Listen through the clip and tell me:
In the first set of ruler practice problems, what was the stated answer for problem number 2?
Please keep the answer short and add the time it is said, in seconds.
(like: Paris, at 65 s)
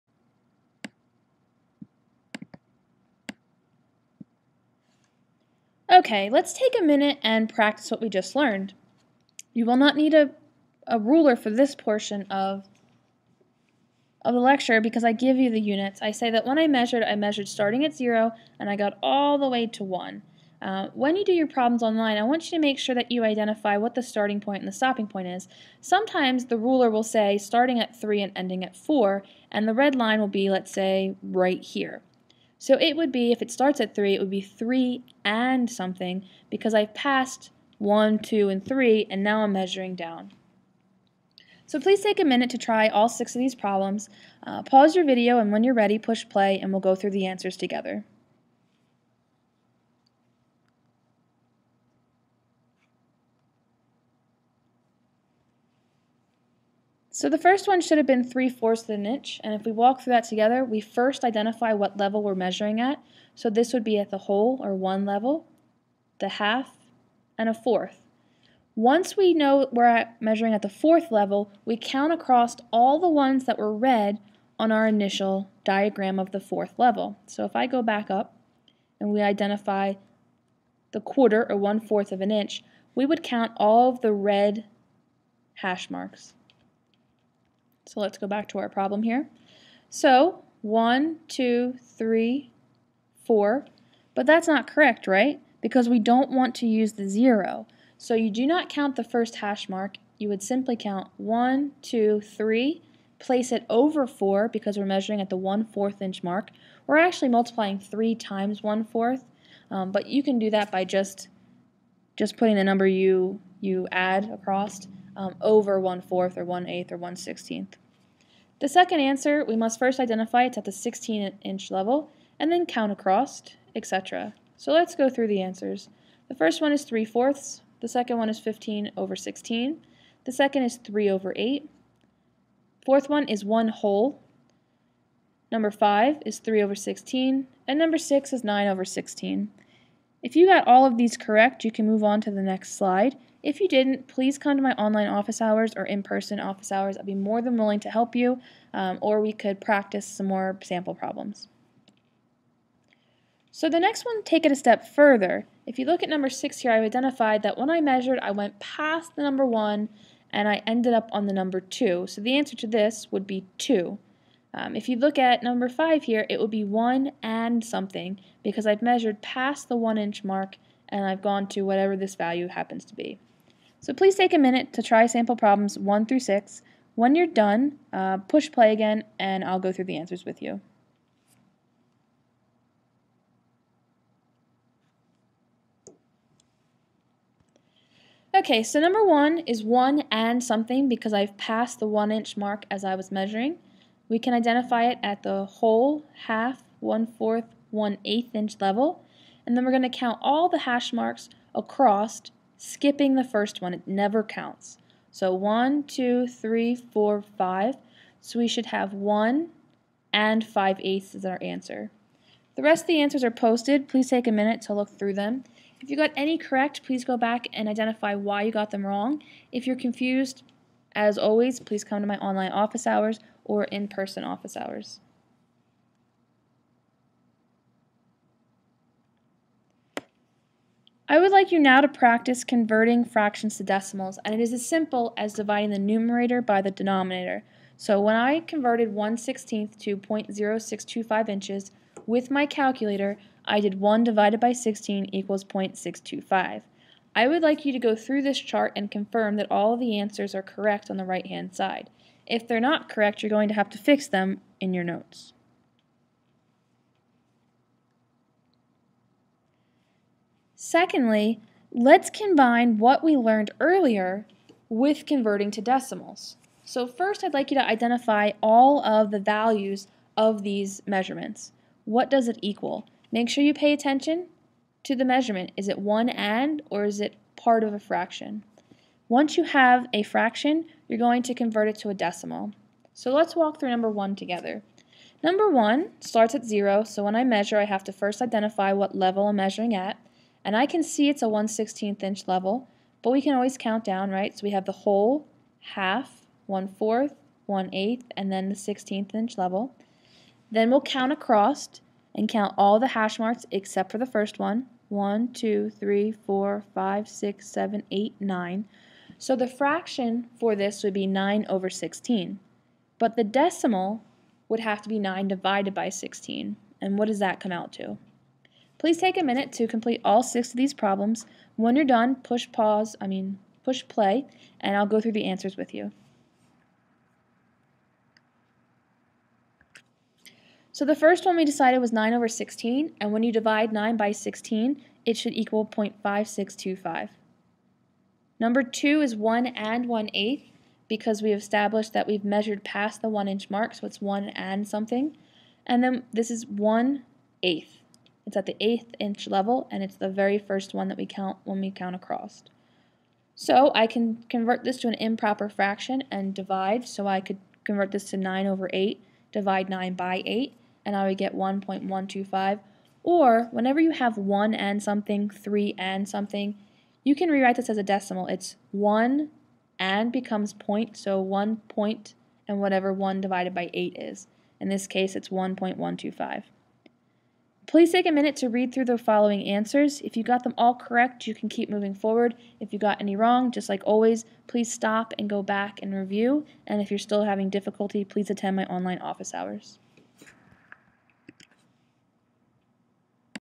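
15/16, at 128 s.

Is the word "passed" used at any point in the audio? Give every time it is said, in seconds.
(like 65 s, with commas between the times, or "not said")
36 s, 191 s.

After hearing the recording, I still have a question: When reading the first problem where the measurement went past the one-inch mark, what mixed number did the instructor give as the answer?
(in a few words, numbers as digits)
1 and 5/8.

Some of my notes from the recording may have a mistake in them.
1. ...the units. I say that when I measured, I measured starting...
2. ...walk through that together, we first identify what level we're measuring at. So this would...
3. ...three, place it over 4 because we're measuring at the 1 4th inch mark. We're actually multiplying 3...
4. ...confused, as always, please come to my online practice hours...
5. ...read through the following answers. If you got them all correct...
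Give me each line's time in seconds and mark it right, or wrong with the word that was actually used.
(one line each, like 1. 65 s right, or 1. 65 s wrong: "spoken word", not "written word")
1. 15 s right
2. 59 s right
3. 102 s right
4. 219 s wrong: "office", not "practice"
5. 378 s right.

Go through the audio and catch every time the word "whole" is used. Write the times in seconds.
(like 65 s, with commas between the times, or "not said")
64 s, 133 s, 195 s, 294 s.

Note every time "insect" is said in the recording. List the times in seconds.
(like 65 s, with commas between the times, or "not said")
not said.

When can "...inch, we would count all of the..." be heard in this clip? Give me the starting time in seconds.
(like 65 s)
82 s.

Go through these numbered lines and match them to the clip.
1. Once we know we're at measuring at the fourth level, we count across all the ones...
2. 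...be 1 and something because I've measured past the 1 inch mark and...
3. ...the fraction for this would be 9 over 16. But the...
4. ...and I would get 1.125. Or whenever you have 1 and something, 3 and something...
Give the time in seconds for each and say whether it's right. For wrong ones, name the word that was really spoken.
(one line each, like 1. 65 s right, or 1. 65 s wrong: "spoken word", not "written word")
1. 68 s right
2. 166 s right
3. 309 s right
4. 360 s right.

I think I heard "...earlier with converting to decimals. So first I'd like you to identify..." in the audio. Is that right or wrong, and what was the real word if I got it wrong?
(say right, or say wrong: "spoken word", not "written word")
right.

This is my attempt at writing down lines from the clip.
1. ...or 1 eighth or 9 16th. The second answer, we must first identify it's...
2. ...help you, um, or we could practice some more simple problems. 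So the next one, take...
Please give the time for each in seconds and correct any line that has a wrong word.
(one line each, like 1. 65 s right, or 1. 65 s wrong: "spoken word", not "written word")
1. 116 s wrong: "1", not "9"
2. 147 s wrong: "sample", not "simple".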